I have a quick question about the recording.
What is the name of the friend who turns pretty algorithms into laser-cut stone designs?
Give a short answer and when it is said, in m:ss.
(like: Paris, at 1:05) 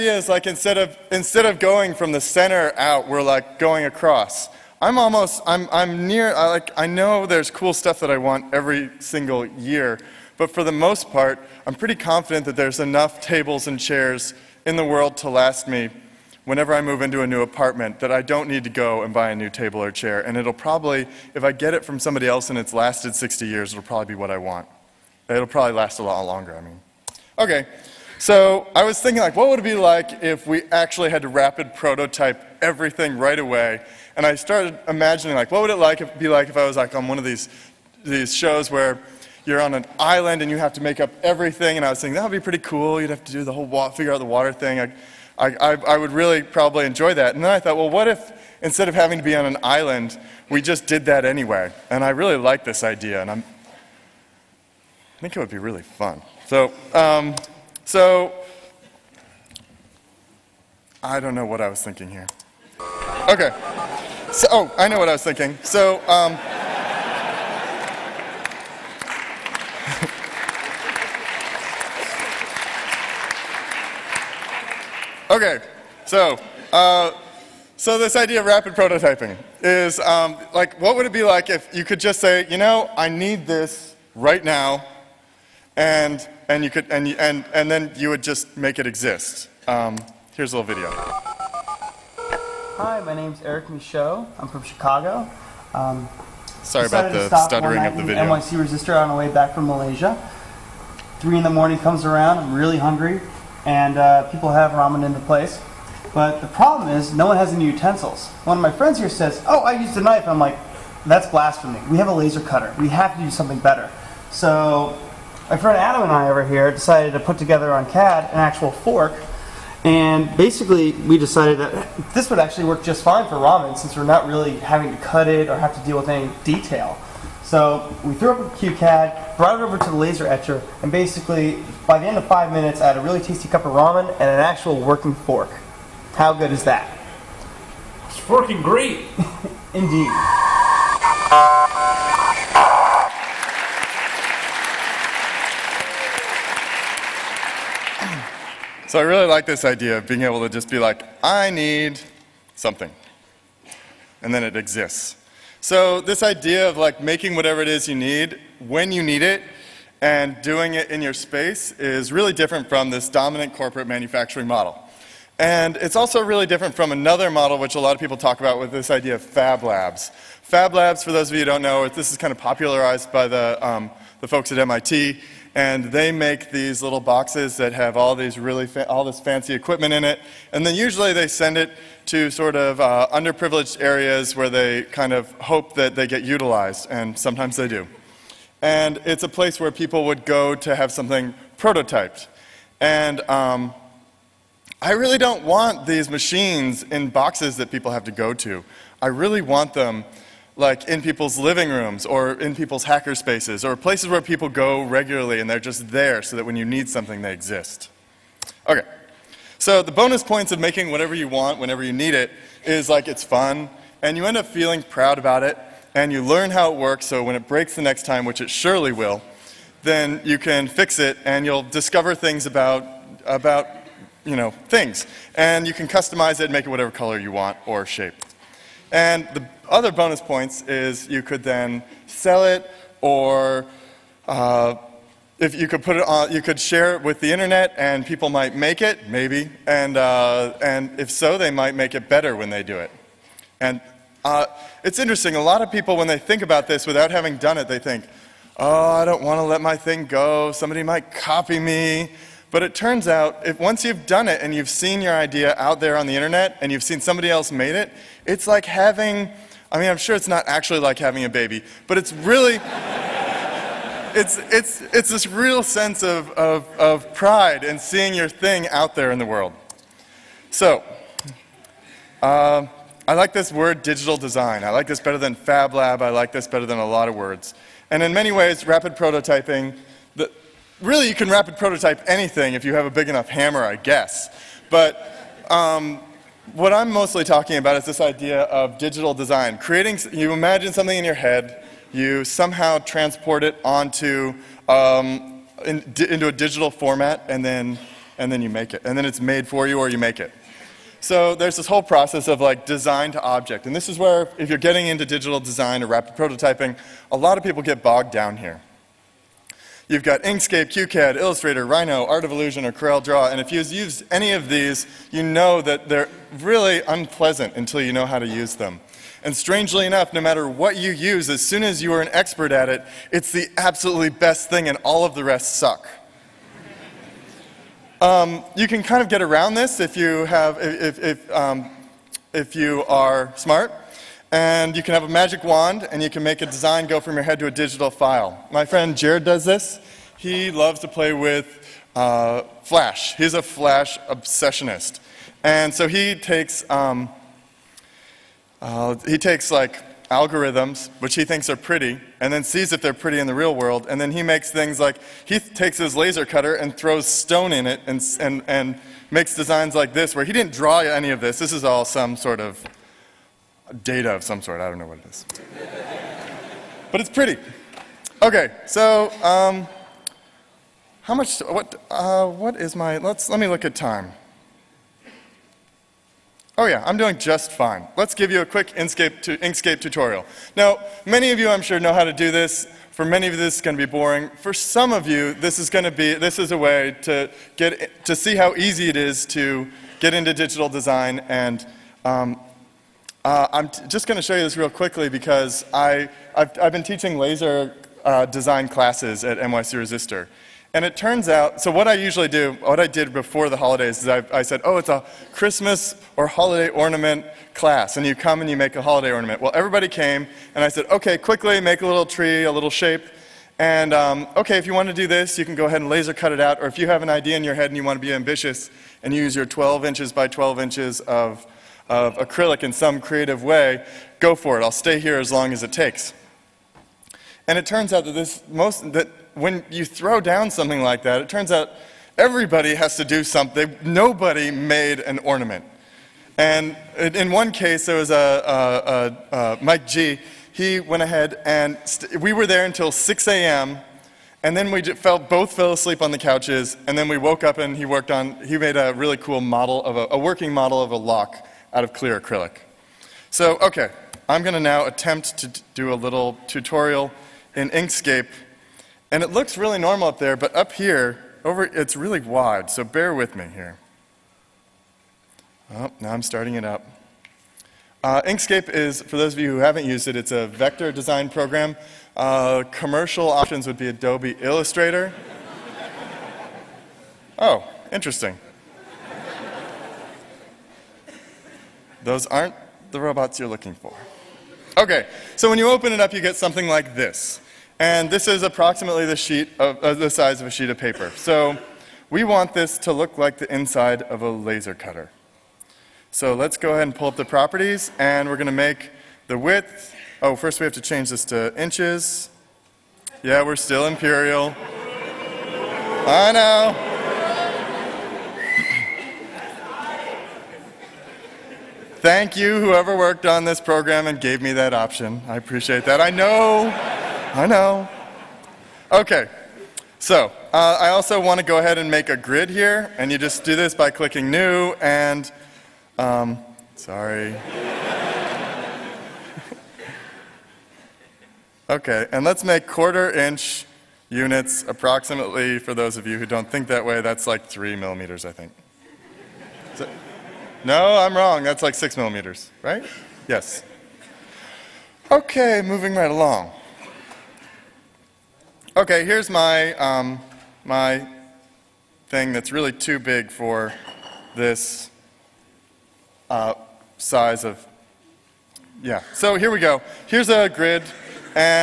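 Jared, at 5:38.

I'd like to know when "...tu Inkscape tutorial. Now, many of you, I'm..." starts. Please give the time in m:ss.
6:19.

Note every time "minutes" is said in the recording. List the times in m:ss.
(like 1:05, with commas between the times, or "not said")
2:12.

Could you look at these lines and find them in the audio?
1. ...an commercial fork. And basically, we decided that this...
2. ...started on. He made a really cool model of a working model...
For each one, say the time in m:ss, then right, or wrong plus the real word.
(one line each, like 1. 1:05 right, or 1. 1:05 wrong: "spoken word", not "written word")
1. 1:58 wrong: "actual", not "commercial"
2. 7:27 wrong: "worked", not "started".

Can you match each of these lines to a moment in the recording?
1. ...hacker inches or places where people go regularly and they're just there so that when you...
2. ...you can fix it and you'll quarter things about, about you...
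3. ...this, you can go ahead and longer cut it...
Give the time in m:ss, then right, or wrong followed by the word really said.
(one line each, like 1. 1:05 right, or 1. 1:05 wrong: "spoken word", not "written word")
1. 3:22 wrong: "spaces", not "inches"
2. 3:40 wrong: "discover", not "quarter"
3. 6:55 wrong: "laser", not "longer".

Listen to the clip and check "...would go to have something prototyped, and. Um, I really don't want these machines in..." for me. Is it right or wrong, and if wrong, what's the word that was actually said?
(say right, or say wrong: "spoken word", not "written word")
right.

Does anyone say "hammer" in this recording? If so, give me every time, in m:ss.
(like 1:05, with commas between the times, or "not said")
4:43.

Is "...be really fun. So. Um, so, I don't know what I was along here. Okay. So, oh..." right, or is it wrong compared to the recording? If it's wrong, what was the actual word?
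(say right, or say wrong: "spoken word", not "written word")
wrong: "thinking", not "along".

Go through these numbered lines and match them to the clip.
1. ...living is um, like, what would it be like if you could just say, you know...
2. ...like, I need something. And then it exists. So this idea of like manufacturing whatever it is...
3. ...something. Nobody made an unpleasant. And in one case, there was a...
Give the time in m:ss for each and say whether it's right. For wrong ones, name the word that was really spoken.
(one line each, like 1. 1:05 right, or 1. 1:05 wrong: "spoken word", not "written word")
1. 1:18 wrong: "prototyping", not "living"
2. 2:30 wrong: "making", not "manufacturing"
3. 7:13 wrong: "ornament", not "unpleasant".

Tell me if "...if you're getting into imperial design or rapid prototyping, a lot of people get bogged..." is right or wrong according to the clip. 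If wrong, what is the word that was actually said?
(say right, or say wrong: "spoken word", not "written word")
wrong: "digital", not "imperial".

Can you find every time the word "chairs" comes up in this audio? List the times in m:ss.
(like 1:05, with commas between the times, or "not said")
0:13, 0:19.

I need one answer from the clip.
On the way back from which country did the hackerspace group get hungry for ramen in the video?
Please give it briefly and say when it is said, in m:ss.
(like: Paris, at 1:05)
Malaysia, at 1:39.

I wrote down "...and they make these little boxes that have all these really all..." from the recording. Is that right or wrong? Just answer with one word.
right.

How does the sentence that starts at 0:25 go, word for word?
It'll probably last a lot longer, I mean.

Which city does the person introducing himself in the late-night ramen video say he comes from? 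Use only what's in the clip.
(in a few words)
Chicago.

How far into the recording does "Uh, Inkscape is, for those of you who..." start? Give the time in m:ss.
7:48.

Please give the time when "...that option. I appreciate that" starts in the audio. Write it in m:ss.
8:34.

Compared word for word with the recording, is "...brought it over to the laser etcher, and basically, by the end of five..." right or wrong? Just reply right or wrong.
right.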